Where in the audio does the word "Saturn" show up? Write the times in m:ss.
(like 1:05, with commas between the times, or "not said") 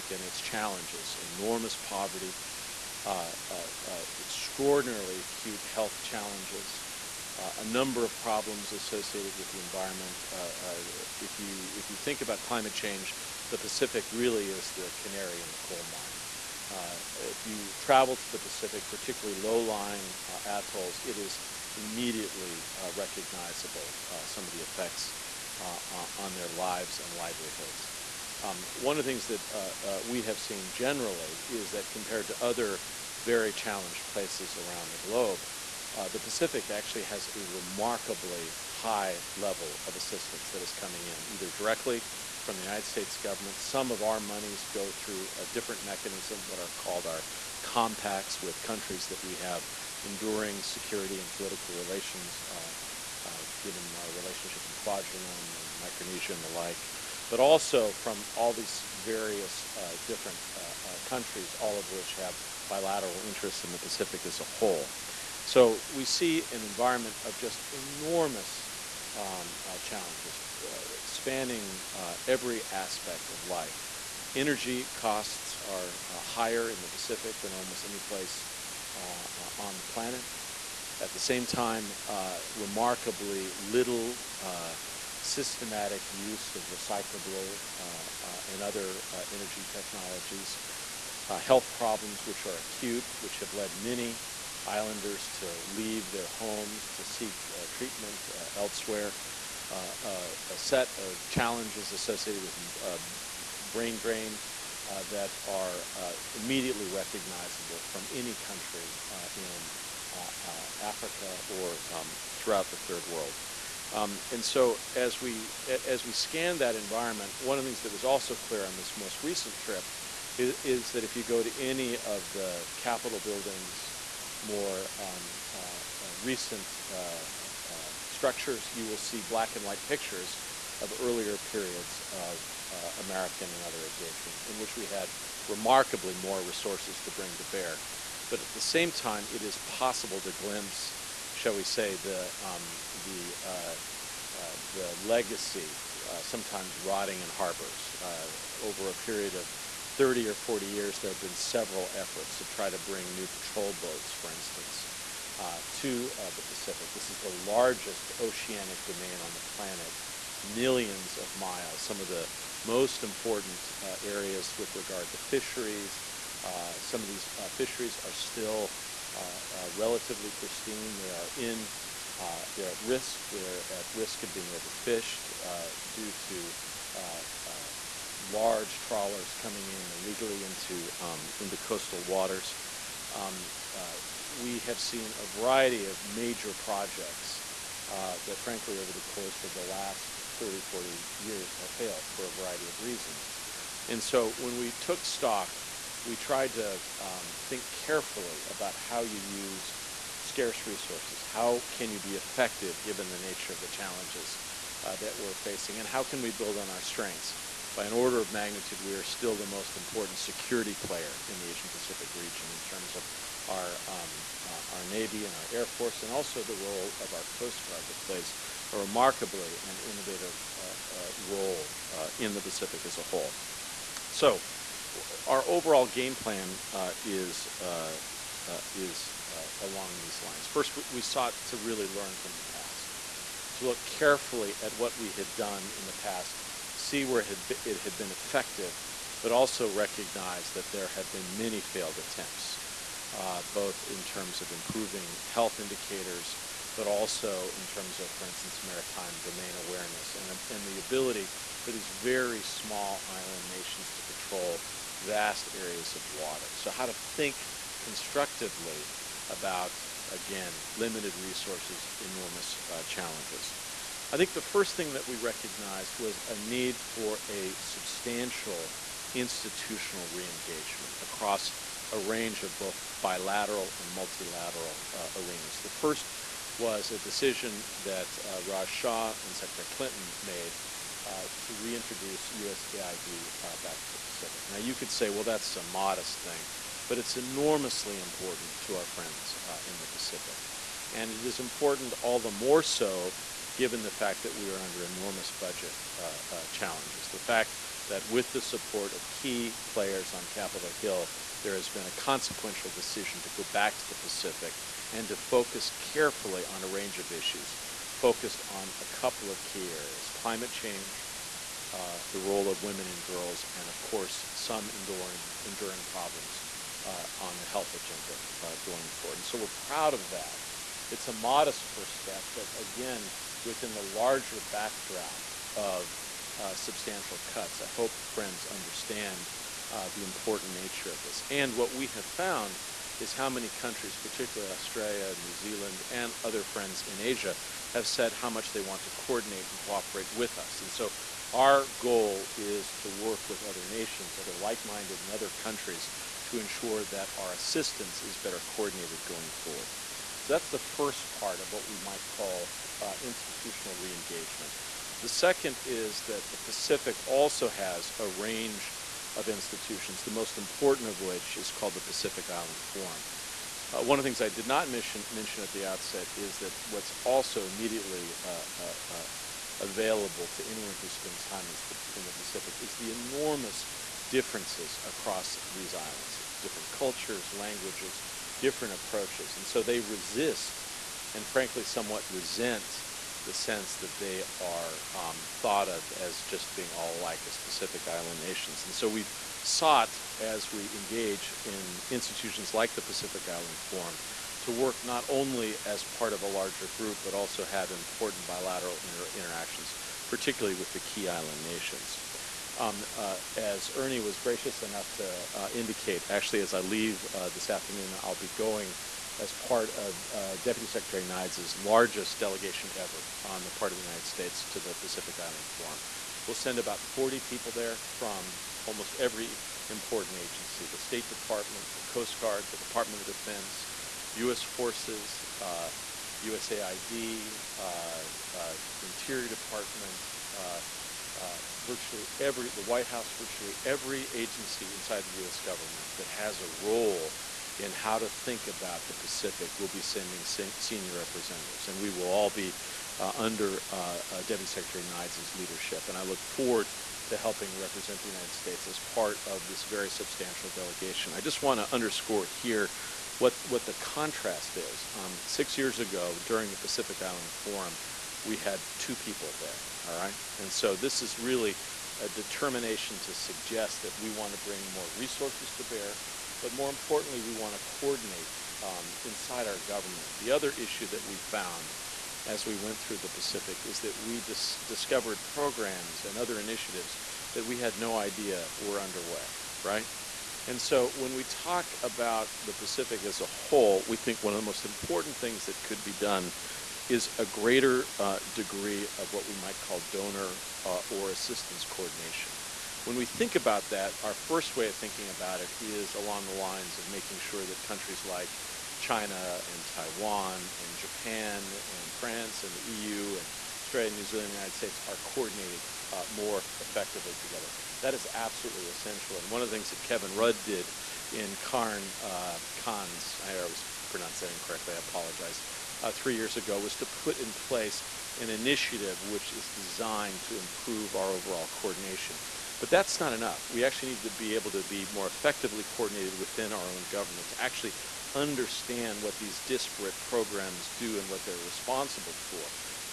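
not said.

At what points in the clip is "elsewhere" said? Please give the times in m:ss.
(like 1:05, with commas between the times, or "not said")
1:38.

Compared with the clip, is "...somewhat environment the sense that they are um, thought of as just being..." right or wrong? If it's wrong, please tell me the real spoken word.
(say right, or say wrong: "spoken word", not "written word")
wrong: "resent", not "environment".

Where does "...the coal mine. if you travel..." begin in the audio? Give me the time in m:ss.
0:15.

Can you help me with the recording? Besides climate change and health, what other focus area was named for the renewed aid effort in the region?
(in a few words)
Women and girls.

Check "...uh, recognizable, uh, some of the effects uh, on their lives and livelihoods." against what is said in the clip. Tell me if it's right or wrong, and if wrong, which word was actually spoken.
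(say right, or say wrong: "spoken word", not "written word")
right.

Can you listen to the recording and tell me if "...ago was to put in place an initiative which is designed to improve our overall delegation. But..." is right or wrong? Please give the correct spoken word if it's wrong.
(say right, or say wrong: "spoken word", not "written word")
wrong: "coordination", not "delegation".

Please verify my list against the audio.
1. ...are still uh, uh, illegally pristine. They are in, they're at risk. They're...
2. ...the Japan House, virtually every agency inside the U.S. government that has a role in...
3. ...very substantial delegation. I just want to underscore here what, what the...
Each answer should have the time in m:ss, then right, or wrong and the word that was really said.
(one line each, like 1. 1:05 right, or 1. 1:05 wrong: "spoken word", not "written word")
1. 2:48 wrong: "relatively", not "illegally"
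2. 7:12 wrong: "White", not "Japan"
3. 7:29 right.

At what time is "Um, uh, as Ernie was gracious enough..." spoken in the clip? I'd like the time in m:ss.
6:42.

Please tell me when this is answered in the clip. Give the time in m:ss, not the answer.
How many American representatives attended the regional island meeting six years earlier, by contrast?
7:38.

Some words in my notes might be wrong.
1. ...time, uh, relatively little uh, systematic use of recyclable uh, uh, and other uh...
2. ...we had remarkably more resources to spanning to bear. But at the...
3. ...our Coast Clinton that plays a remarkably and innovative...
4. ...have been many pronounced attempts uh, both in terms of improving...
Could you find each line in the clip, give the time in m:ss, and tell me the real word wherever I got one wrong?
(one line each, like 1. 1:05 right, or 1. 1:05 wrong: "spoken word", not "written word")
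1. 1:21 wrong: "remarkably", not "relatively"
2. 2:14 wrong: "bring", not "spanning"
3. 3:37 wrong: "Guard", not "Clinton"
4. 4:00 wrong: "failed", not "pronounced".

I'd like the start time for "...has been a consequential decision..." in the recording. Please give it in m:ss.
5:01.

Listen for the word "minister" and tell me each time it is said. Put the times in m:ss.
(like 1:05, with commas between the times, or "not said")
not said.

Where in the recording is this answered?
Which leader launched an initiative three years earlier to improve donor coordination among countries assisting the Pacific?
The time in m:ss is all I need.
8:29.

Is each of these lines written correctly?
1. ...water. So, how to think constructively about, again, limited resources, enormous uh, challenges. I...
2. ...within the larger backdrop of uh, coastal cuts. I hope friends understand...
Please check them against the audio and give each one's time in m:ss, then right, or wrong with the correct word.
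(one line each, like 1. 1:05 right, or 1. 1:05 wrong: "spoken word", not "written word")
1. 4:16 right
2. 5:23 wrong: "substantial", not "coastal".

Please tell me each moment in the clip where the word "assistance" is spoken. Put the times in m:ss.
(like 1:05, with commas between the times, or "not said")
0:39, 5:47, 8:11.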